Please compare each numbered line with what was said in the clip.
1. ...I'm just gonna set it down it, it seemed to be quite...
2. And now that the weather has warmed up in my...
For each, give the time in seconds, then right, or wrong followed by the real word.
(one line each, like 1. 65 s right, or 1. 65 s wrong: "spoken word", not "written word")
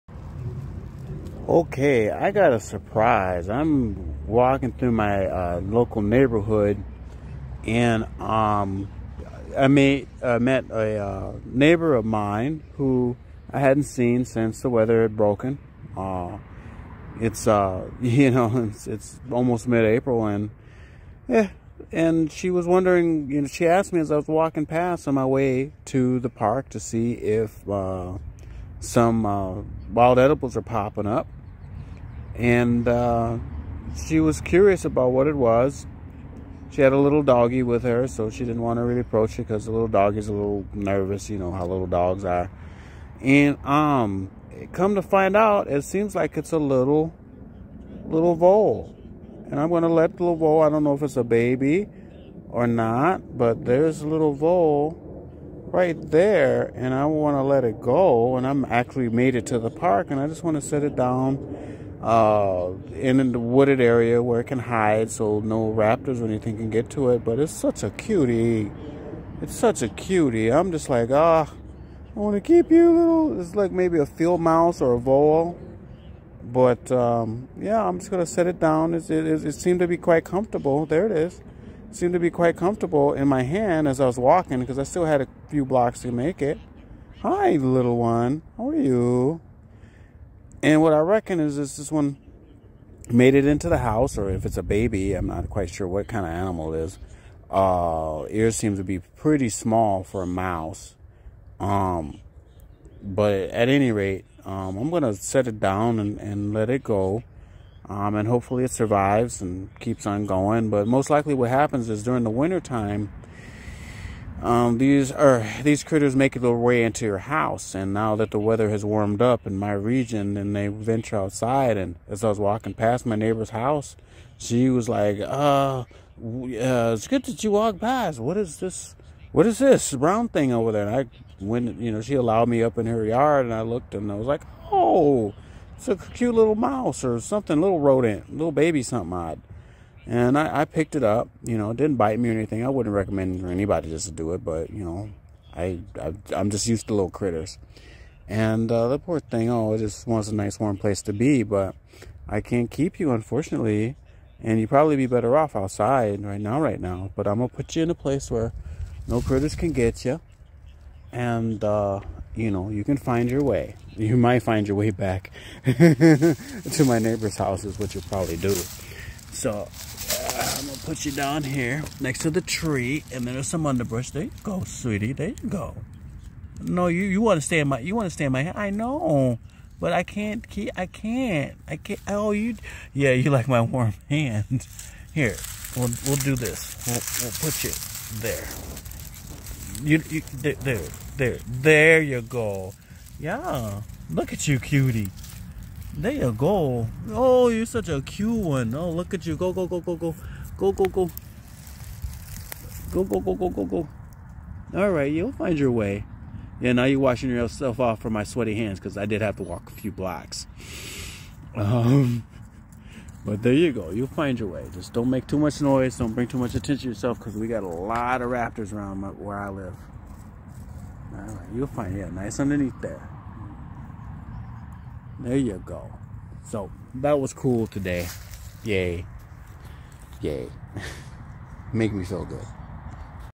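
1. 77 s right
2. 117 s right.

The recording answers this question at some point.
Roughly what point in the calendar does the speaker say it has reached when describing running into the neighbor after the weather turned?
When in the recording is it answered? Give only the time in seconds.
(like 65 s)
19 s.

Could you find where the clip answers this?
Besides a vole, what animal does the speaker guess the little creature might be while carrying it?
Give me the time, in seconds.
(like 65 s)
74 s.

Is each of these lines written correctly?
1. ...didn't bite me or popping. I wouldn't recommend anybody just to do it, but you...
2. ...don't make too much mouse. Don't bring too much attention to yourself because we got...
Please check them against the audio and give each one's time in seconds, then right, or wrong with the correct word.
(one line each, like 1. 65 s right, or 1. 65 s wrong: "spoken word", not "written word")
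1. 141 s wrong: "anything", not "popping"
2. 214 s wrong: "noise", not "mouse".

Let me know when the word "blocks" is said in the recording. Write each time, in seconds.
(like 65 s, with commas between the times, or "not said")
85 s, 209 s.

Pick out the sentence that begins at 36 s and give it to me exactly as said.
She had a little doggy with her, so she didn't want to really approach it because the little doggy's a little nervous.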